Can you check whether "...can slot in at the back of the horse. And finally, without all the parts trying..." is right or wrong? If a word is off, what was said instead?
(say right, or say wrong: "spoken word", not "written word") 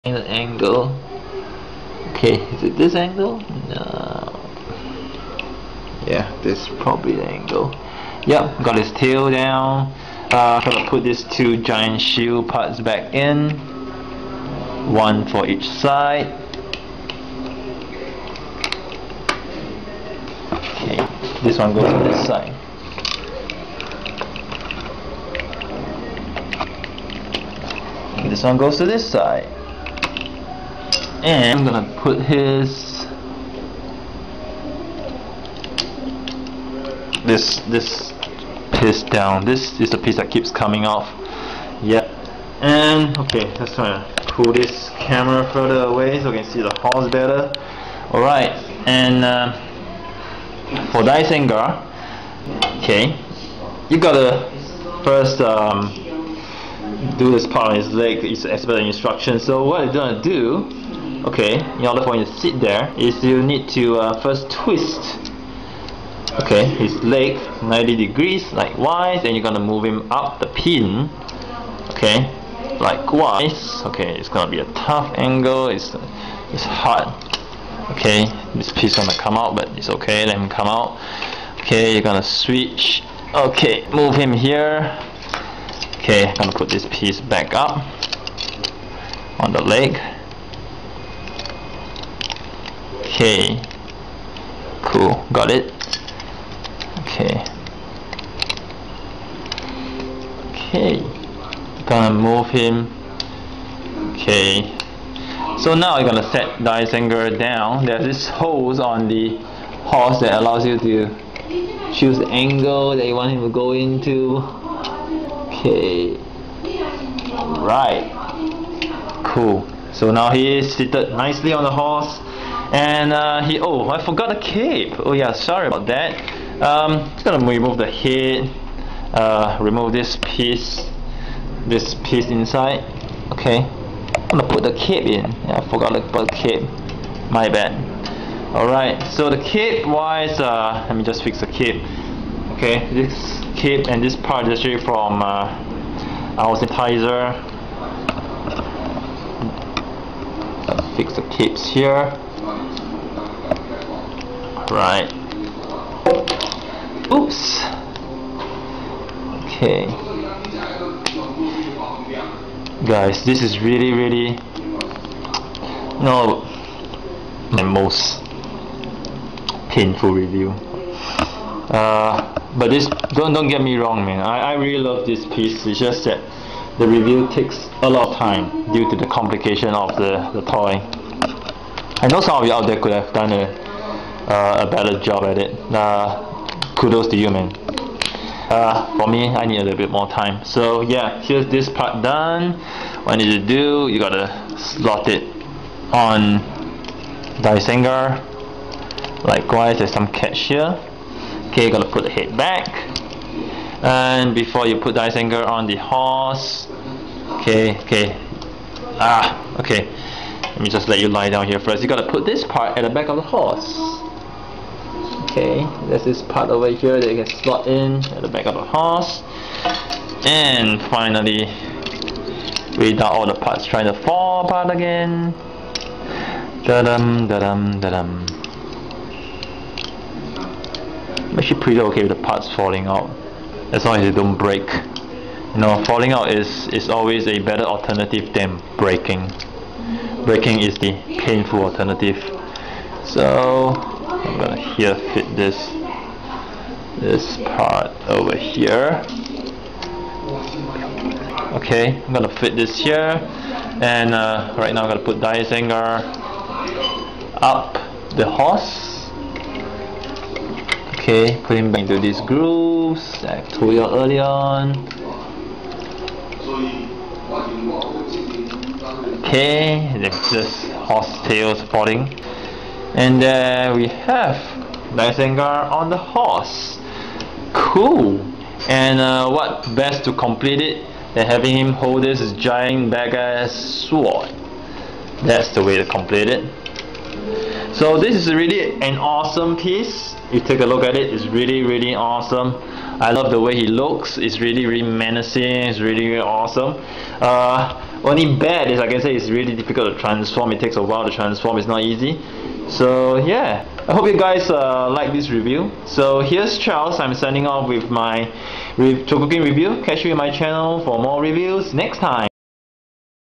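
right.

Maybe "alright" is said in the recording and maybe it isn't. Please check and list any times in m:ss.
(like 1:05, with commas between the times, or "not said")
0:48, 2:18.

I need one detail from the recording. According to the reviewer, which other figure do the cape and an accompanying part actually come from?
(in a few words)
Aubenseiter.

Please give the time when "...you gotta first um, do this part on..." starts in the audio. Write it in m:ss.
0:53.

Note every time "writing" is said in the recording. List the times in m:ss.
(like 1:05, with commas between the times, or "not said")
not said.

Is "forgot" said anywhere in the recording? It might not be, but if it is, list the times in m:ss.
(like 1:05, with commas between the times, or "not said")
2:04, 2:15.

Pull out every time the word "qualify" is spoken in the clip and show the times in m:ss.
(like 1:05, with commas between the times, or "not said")
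not said.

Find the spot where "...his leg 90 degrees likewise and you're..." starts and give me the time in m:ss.
1:06.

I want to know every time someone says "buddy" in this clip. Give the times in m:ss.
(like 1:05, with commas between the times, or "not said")
not said.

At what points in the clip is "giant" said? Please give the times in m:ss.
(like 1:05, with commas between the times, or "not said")
0:11, 4:42.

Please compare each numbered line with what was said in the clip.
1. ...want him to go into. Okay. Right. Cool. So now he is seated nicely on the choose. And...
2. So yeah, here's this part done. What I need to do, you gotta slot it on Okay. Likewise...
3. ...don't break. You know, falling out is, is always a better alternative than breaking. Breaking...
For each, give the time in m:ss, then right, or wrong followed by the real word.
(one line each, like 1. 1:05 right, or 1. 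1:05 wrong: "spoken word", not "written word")
1. 1:53 wrong: "horse", not "choose"
2. 3:10 wrong: "Dygenguar", not "Okay"
3. 3:54 right.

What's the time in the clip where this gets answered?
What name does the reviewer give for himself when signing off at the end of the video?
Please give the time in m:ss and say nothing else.
5:06.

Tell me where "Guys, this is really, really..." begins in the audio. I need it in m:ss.
2:42.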